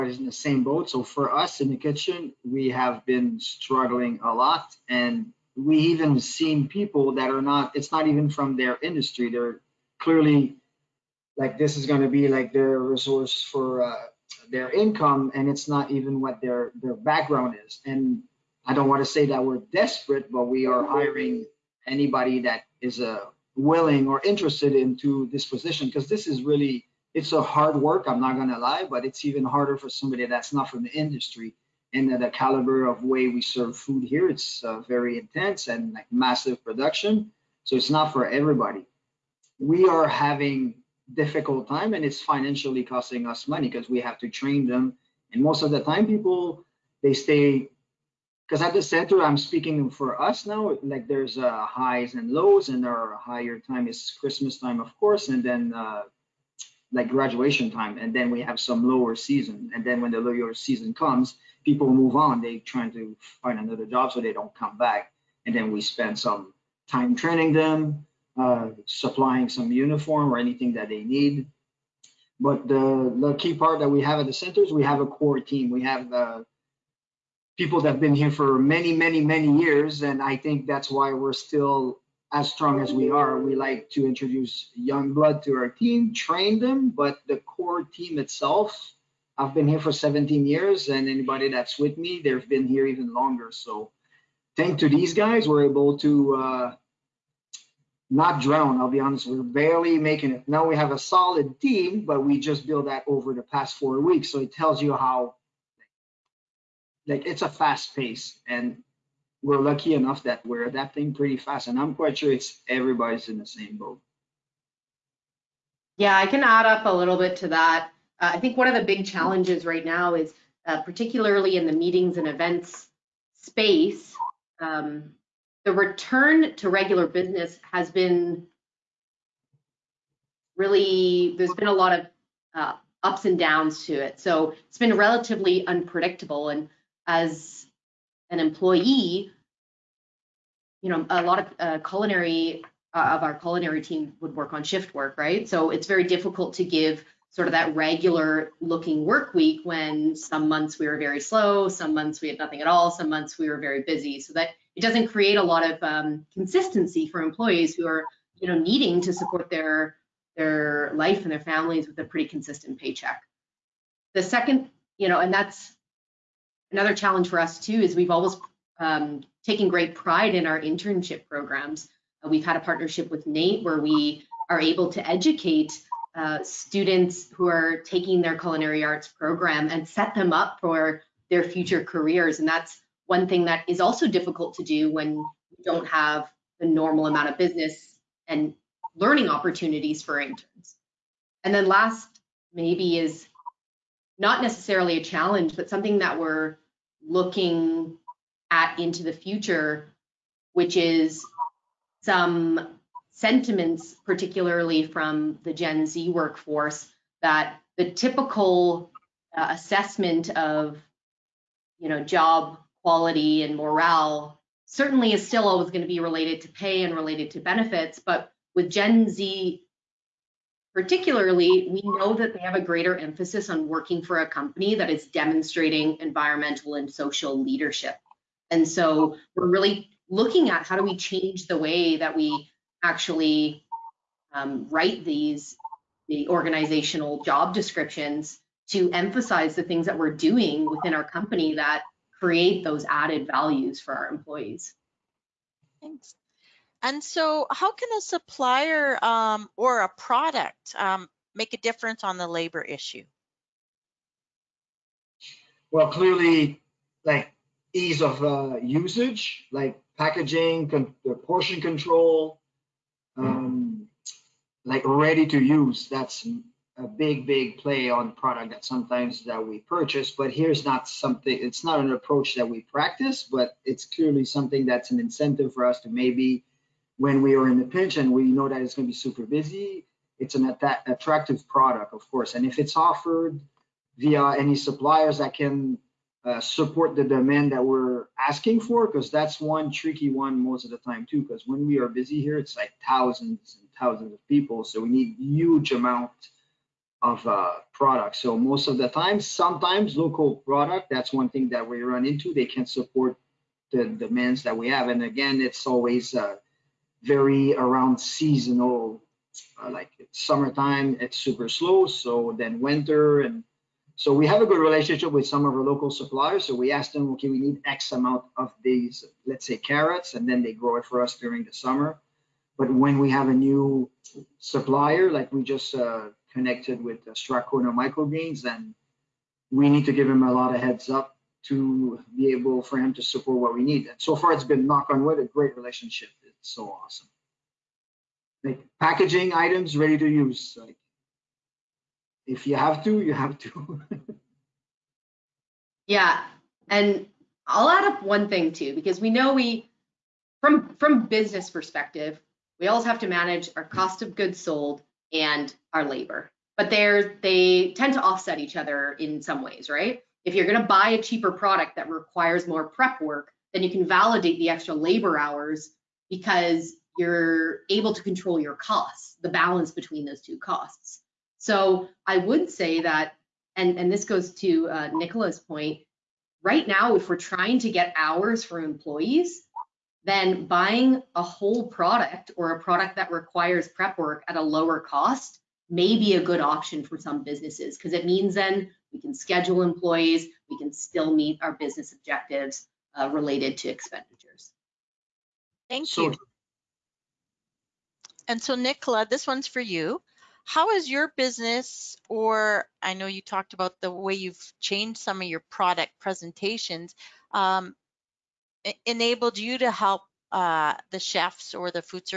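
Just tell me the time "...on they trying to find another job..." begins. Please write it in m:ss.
1:02.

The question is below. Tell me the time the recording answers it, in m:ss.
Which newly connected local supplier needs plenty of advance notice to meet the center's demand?
5:27.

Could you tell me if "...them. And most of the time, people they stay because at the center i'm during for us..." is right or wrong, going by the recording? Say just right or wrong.
wrong.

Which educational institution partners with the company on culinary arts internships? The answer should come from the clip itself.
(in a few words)
NAIT.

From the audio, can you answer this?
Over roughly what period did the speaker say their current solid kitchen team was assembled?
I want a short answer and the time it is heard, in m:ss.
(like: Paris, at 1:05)
four weeks, at 1:43.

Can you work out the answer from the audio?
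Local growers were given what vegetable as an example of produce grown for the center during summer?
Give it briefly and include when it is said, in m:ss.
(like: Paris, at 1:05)
carrots, at 5:19.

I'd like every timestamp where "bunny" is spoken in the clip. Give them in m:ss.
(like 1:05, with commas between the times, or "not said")
not said.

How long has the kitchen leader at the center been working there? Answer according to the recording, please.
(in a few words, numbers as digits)
17 years.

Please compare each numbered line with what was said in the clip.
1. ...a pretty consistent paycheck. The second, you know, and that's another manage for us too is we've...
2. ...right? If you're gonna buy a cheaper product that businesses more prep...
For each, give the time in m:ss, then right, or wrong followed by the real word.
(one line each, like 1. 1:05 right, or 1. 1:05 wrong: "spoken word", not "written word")
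1. 2:41 wrong: "challenge", not "manage"
2. 5:59 wrong: "requires", not "businesses".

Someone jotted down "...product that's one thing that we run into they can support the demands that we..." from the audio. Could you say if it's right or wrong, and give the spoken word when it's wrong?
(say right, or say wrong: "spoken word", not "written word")
right.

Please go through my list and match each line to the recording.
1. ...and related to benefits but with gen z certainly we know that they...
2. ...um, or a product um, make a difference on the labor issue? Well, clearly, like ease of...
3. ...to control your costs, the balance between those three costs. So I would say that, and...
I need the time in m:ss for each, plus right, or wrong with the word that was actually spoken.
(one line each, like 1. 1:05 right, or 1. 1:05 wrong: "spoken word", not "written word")
1. 3:36 wrong: "particularly", not "certainly"
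2. 4:09 right
3. 6:07 wrong: "two", not "three".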